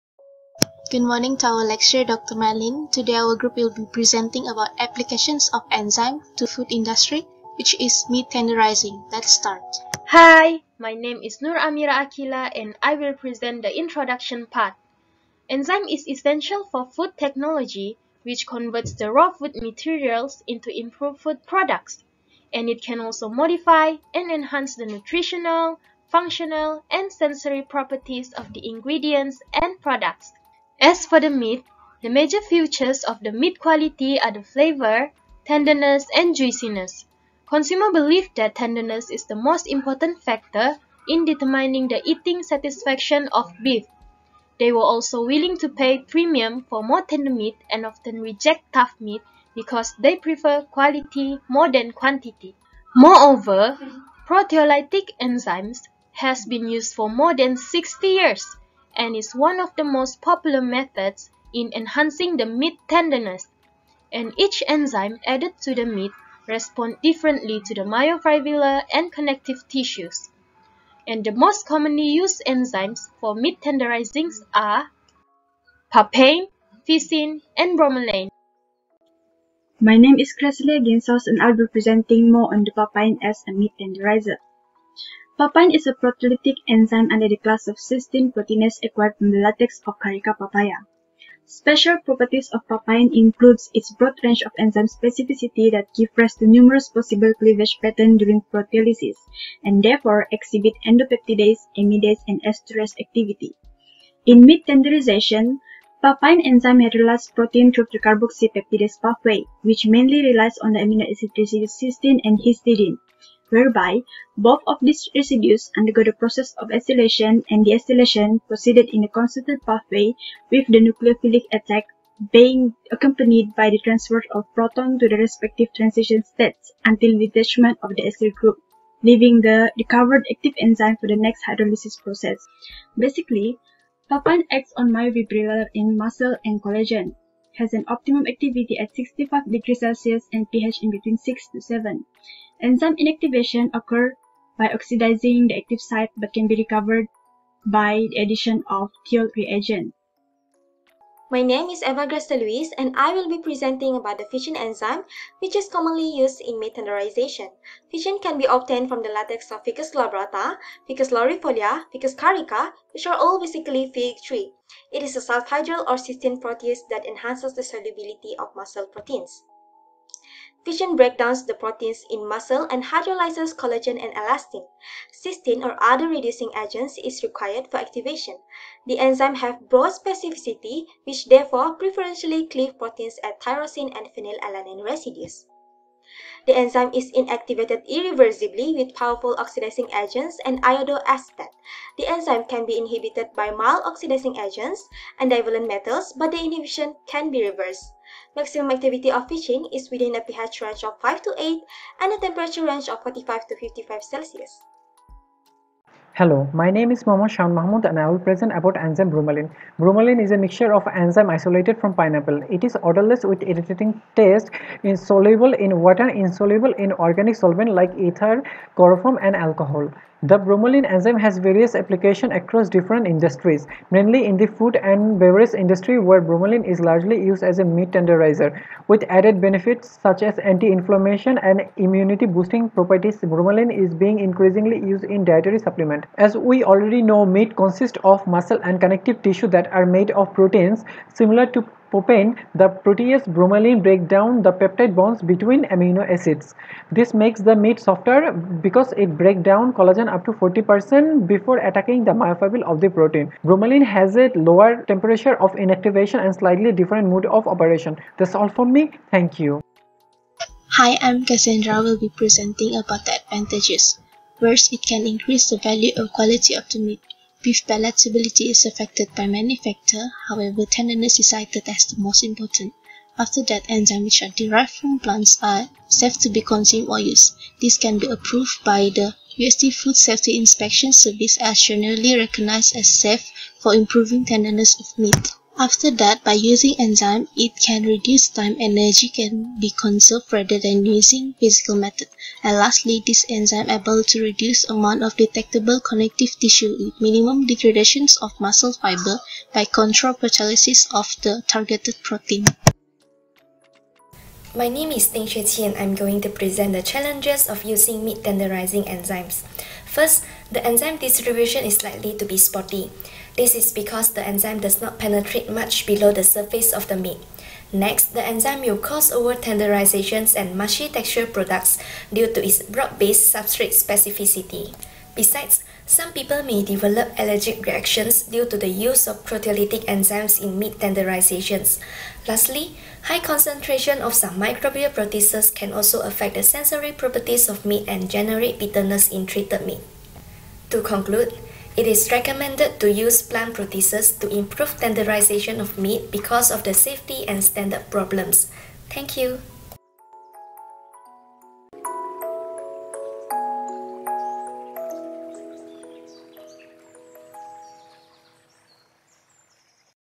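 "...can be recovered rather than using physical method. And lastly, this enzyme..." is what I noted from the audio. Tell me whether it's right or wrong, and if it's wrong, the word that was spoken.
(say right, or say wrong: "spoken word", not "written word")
wrong: "conserved", not "recovered".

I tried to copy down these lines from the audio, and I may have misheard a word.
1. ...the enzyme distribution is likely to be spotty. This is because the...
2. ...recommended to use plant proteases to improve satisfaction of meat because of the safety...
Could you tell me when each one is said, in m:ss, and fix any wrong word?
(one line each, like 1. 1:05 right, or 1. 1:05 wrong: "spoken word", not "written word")
1. 5:10 right
2. 5:42 wrong: "tenderization", not "satisfaction".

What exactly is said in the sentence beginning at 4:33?
After that, enzymes which are derived from plants are safe to be consumed or used.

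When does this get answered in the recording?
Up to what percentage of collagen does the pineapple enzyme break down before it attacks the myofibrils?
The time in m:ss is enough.
4:10.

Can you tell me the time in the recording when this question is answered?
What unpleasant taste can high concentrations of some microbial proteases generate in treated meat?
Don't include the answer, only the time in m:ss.
5:38.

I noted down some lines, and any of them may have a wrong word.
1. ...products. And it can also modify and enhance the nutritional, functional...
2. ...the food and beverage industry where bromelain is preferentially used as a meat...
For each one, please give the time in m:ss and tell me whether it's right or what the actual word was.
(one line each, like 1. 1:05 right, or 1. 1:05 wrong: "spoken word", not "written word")
1. 0:21 right
2. 3:44 wrong: "largely", not "preferentially".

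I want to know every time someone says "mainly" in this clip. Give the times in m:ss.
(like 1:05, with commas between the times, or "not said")
1:49, 3:43.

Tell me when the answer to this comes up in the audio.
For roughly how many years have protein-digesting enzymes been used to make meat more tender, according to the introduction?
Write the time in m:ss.
0:57.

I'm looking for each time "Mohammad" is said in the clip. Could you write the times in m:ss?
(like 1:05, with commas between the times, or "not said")
3:27.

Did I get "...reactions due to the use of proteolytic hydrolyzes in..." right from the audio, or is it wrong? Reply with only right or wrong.
wrong.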